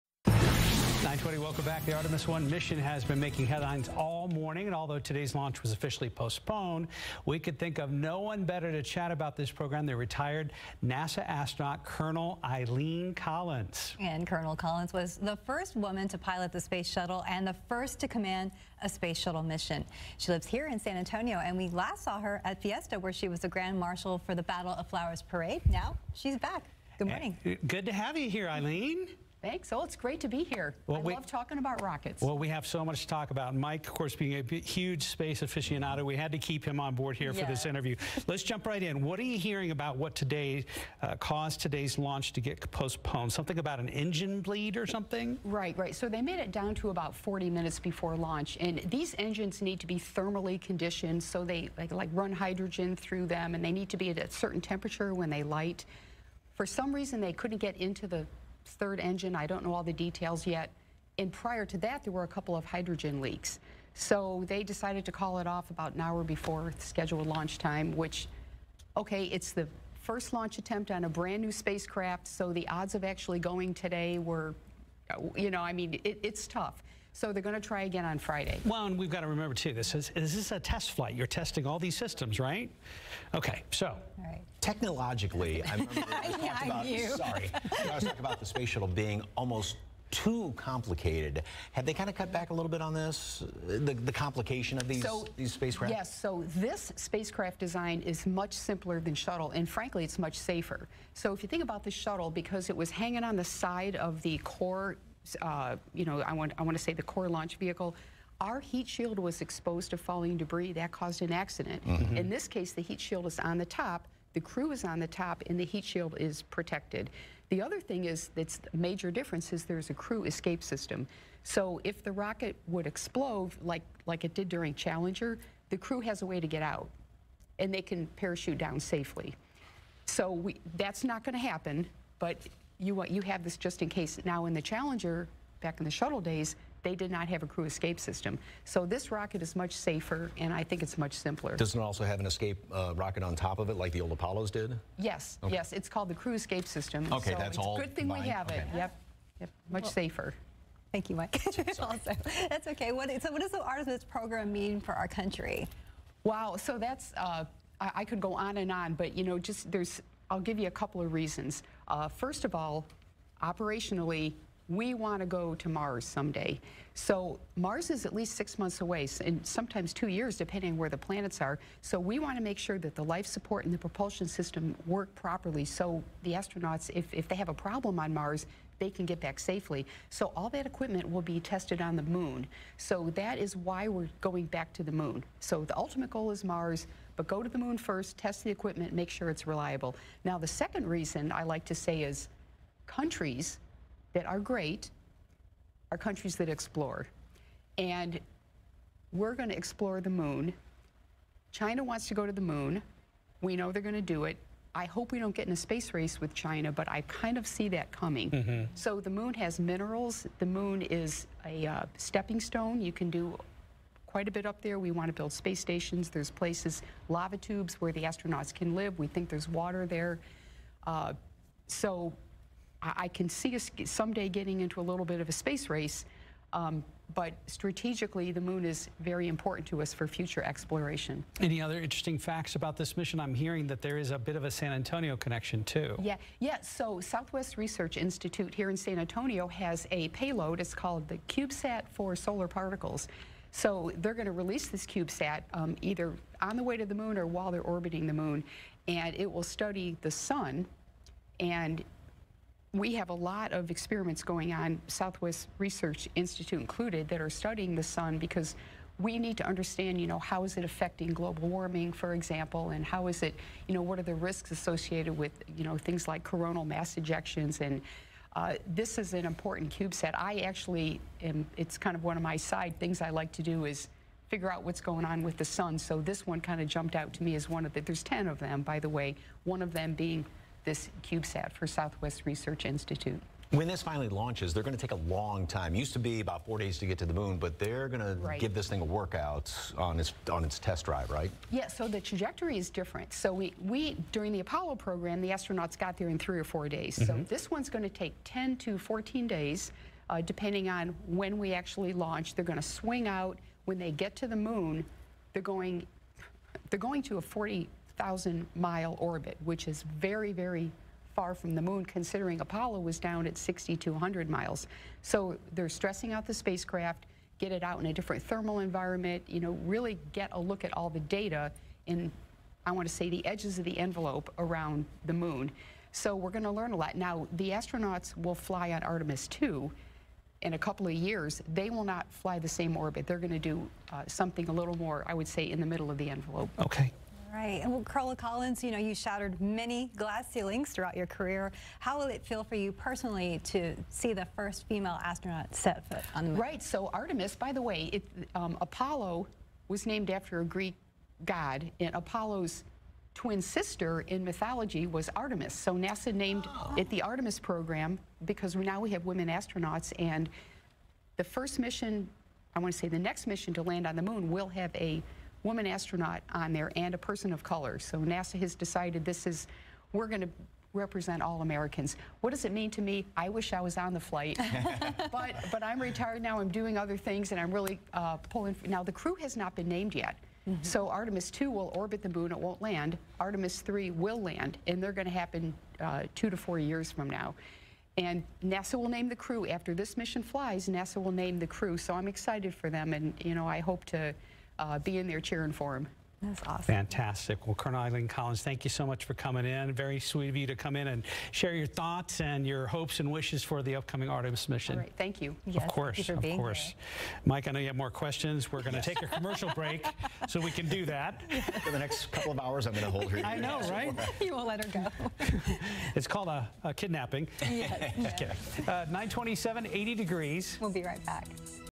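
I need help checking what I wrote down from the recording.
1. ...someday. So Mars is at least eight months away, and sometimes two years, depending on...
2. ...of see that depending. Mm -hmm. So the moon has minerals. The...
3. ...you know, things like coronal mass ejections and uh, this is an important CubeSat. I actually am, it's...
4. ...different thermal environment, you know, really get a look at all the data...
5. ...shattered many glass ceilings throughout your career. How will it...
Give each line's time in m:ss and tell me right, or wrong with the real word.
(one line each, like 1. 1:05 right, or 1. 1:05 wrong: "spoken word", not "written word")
1. 2:46 wrong: "six", not "eight"
2. 3:27 wrong: "coming", not "depending"
3. 4:25 right
4. 5:17 right
5. 5:38 right.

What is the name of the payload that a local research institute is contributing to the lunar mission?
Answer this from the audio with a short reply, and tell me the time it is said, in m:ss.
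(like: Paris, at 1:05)
CubeSat for Solar Particles, at 4:01.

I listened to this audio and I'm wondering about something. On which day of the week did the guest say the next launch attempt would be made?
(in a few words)
Friday.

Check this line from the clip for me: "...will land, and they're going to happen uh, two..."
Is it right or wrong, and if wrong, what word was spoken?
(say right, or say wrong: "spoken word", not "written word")
right.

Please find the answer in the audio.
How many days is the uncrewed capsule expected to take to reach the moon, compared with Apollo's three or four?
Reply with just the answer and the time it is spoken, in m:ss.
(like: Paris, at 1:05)
10 to 14 days, at 4:58.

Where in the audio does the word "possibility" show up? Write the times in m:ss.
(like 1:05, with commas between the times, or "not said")
not said.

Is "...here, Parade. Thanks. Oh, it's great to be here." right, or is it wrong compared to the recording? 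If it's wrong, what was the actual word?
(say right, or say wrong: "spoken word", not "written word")
wrong: "Eileen", not "Parade".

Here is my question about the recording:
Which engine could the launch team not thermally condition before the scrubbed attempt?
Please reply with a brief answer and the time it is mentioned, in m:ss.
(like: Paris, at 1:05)
third engine, at 0:58.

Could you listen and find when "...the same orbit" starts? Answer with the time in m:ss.
5:32.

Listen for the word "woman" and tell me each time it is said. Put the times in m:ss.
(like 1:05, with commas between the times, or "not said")
0:15, 6:05.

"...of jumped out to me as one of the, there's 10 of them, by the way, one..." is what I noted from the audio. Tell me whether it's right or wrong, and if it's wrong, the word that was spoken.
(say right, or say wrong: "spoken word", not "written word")
right.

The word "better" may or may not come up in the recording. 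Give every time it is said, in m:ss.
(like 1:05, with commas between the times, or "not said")
0:08.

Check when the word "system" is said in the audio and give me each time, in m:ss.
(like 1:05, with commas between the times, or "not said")
1:21, 2:00, 2:17, 2:26, 2:54.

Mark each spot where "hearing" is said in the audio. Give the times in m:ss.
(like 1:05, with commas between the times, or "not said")
0:39, 3:53.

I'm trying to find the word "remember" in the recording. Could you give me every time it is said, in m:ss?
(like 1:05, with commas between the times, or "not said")
1:19, 1:25.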